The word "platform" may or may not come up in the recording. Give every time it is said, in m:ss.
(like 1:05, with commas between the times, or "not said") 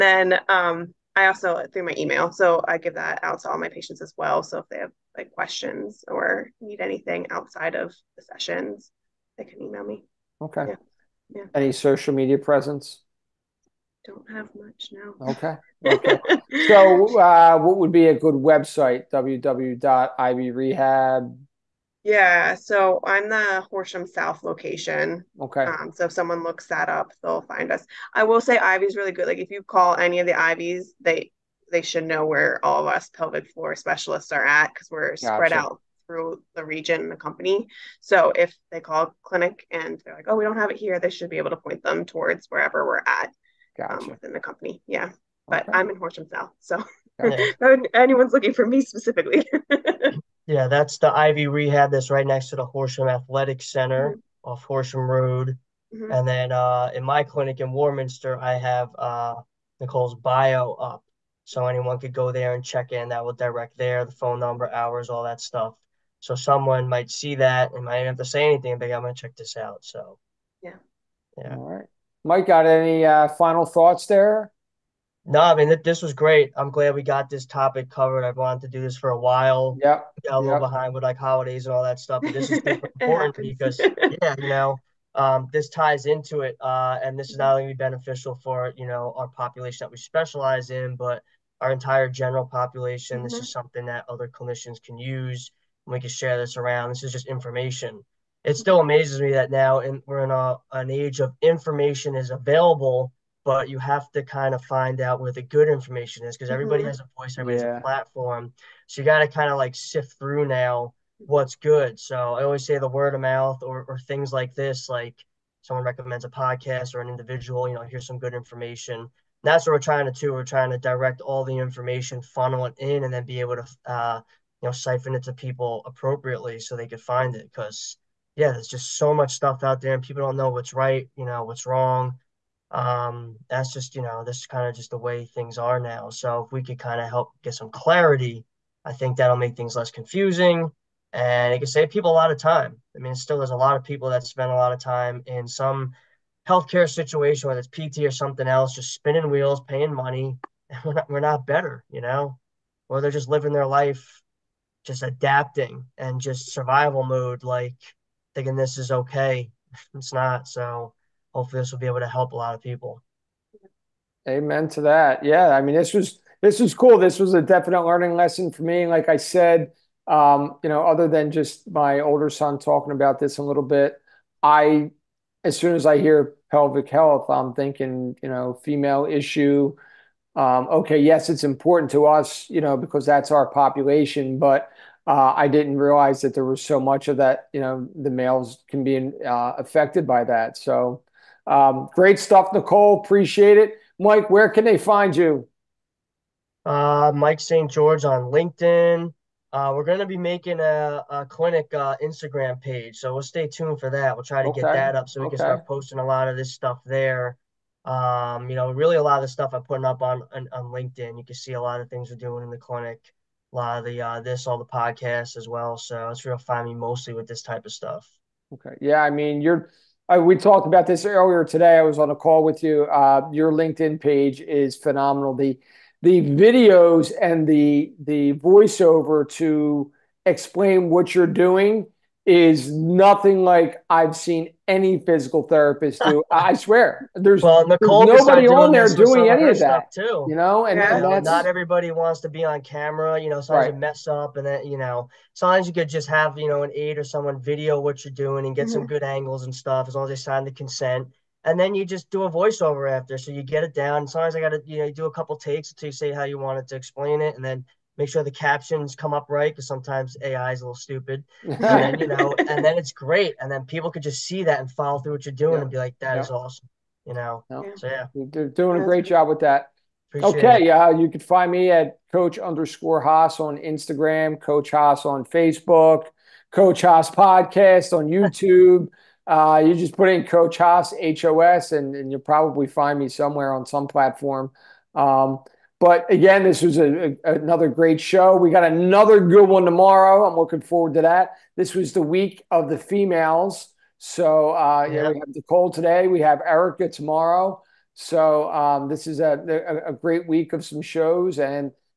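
1:47, 4:43.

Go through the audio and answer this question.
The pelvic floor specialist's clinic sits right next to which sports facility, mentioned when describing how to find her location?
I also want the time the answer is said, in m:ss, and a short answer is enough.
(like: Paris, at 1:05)
Horsham Athletic Center, at 0:52.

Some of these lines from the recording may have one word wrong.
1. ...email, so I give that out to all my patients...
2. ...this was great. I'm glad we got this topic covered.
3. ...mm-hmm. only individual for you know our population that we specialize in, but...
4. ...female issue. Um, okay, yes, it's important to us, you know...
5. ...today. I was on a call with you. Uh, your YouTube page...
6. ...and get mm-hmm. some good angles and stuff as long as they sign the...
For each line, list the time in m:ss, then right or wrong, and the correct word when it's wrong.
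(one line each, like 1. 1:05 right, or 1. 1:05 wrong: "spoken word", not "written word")
1. 0:01 right
2. 1:15 right
3. 1:27 wrong: "beneficial", not "individual"
4. 2:58 right
5. 3:41 wrong: "LinkedIn", not "YouTube"
6. 4:08 right.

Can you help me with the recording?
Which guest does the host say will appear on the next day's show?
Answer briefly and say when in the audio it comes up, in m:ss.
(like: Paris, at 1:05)
Erica, at 4:56.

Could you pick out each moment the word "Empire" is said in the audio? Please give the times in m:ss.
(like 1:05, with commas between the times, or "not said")
not said.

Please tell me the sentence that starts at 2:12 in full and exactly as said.
Um, that's just you know, this is kind of just the way things are now.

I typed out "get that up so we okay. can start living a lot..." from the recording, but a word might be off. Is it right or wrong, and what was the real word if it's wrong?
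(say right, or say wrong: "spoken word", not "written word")
wrong: "posting", not "living".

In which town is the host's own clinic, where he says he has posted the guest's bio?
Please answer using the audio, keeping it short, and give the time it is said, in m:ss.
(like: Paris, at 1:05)
Warminster, at 0:57.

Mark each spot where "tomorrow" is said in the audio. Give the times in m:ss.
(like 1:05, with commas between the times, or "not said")
4:49, 4:56.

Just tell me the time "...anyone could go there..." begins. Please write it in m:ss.
1:01.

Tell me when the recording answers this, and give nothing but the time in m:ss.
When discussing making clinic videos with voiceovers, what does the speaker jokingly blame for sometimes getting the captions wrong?
4:20.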